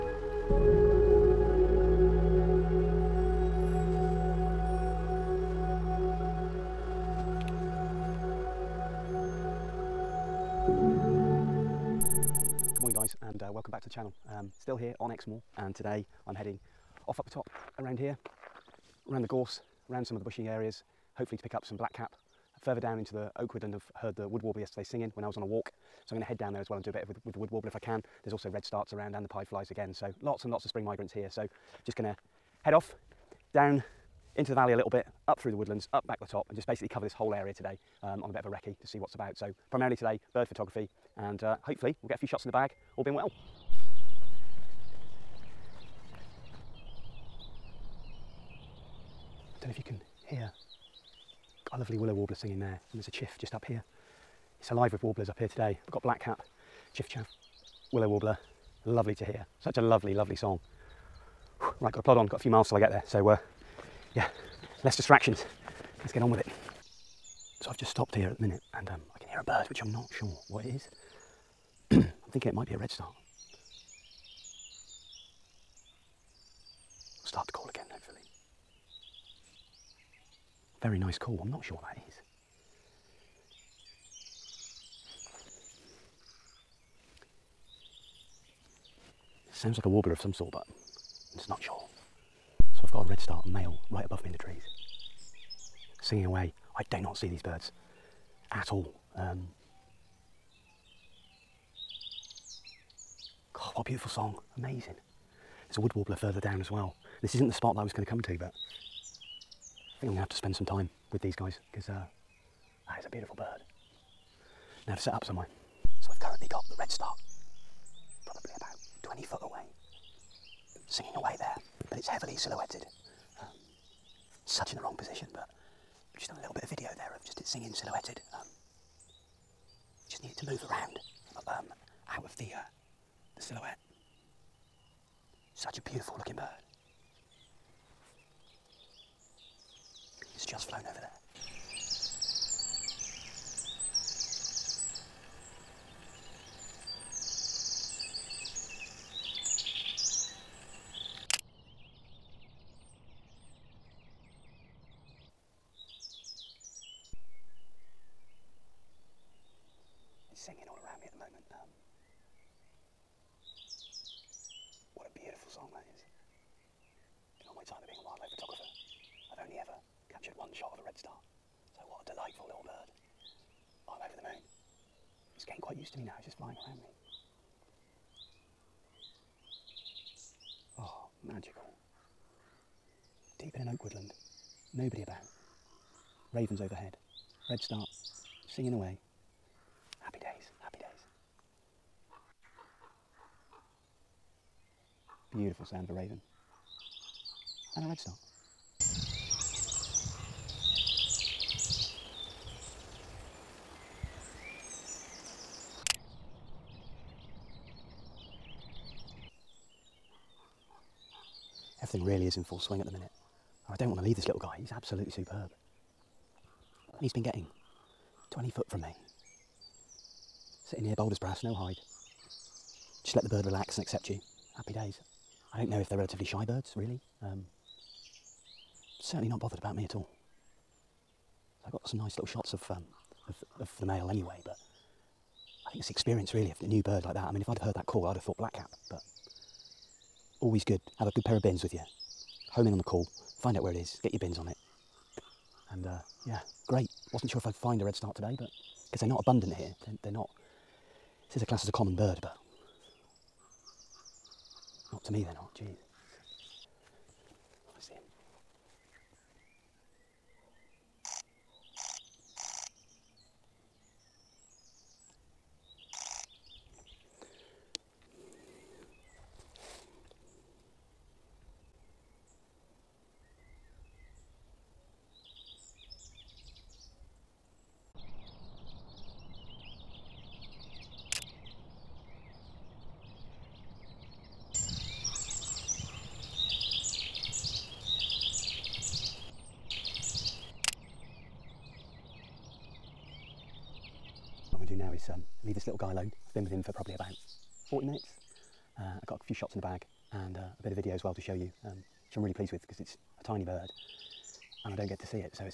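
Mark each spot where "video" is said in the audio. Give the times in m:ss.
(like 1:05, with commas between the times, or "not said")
2:06, 5:00.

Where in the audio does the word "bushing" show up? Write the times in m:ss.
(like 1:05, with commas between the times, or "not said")
0:20.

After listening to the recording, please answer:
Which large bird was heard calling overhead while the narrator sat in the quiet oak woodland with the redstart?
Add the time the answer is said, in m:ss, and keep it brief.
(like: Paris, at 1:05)
Raven, at 3:06.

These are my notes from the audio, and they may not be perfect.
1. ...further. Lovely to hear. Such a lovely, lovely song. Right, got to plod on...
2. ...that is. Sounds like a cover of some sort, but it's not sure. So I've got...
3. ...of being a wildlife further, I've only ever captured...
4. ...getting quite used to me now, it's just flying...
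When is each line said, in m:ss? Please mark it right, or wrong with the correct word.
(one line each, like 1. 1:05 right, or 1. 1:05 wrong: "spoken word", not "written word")
1. 0:58 wrong: "warbler", not "further"
2. 1:21 wrong: "warbler", not "cover"
3. 2:47 wrong: "photographer", not "further"
4. 2:55 right.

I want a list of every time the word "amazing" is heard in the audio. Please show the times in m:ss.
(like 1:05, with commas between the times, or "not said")
1:44.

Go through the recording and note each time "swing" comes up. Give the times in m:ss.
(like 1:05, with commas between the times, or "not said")
3:32.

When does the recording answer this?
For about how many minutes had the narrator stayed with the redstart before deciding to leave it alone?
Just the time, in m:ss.
4:57.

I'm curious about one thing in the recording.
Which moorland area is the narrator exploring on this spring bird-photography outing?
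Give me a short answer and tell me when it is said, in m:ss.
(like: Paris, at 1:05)
Exmoor, at 0:15.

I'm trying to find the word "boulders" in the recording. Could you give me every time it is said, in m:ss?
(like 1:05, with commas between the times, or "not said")
3:40.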